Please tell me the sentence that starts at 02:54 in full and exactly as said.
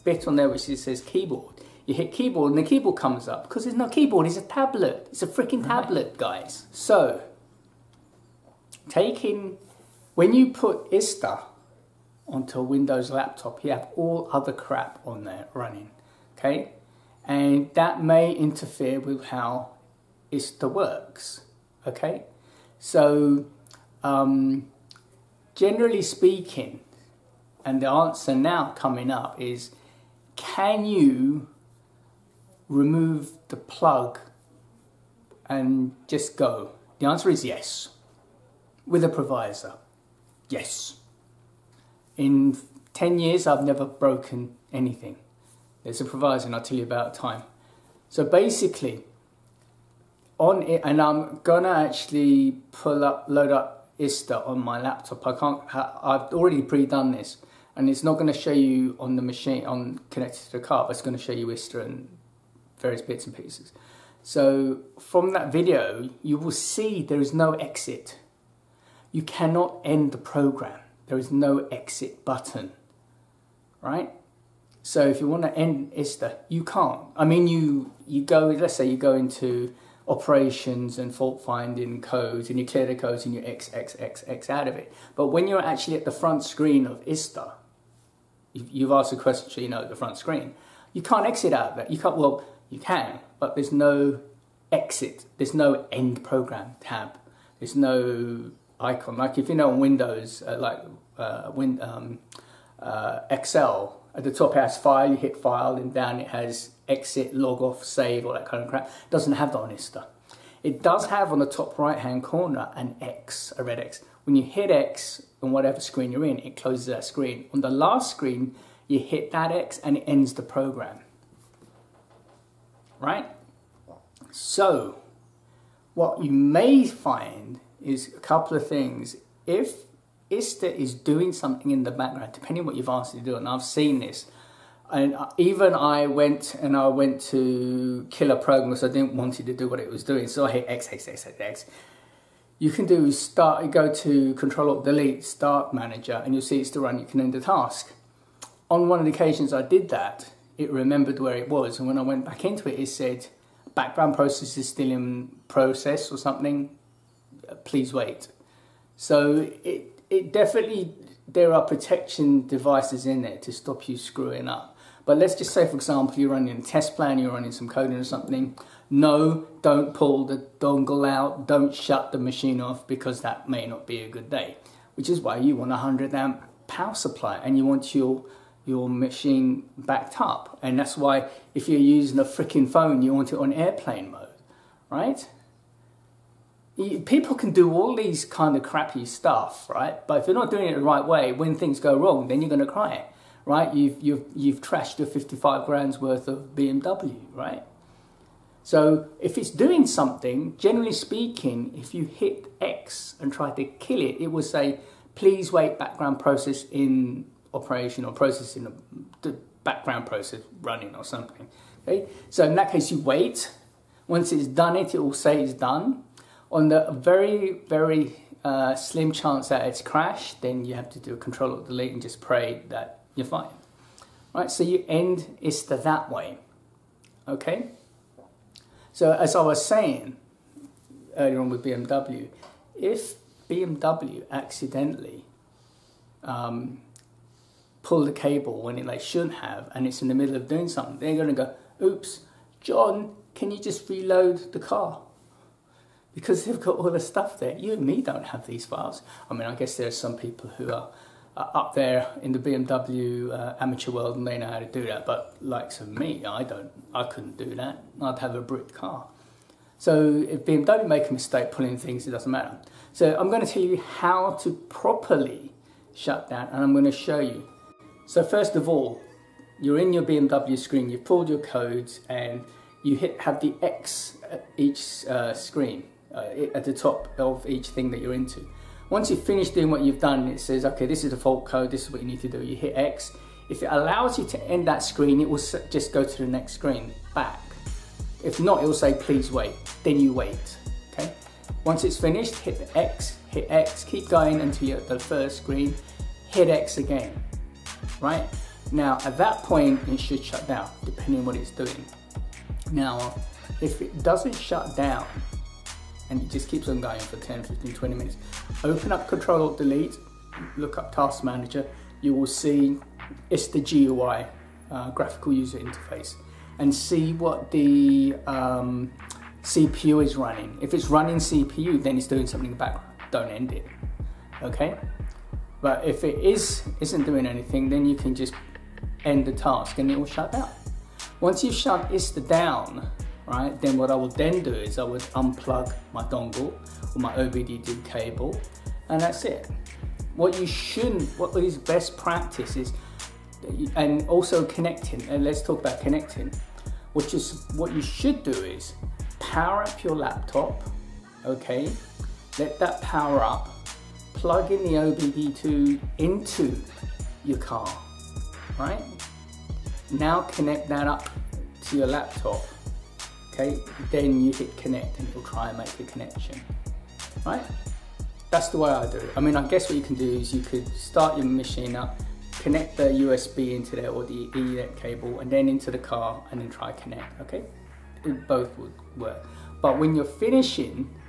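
Which is why you want a 100 amp power supply and you want your your machine backed up.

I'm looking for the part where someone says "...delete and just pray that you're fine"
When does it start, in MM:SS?
03:41.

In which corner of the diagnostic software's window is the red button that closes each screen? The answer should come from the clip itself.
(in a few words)
top right hand corner.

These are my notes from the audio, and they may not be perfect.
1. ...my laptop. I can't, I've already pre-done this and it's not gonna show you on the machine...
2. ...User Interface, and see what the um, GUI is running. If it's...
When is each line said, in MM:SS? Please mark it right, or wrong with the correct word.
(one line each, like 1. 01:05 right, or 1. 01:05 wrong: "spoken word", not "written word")
1. 00:54 right
2. 05:15 wrong: "CPU", not "GUI".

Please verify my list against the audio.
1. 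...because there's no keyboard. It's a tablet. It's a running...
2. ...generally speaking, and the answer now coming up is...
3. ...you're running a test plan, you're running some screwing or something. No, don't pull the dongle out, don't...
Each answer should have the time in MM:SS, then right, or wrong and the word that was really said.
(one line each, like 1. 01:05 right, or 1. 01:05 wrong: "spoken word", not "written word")
1. 00:03 wrong: "freaking", not "running"
2. 00:25 right
3. 02:46 wrong: "coding", not "screwing".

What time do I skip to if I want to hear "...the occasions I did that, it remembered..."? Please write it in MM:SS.
02:29.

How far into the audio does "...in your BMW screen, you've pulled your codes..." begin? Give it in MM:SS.
04:29.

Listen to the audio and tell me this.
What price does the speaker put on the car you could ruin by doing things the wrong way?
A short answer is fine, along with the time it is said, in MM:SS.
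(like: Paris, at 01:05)
55 grand, at 03:15.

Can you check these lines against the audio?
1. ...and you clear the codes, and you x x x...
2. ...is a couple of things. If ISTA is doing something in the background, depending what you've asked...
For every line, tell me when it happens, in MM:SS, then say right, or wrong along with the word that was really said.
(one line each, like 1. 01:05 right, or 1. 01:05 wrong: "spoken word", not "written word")
1. 01:22 right
2. 02:07 right.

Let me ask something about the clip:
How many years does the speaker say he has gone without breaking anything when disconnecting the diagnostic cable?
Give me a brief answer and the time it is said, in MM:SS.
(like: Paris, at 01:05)
10, at 00:42.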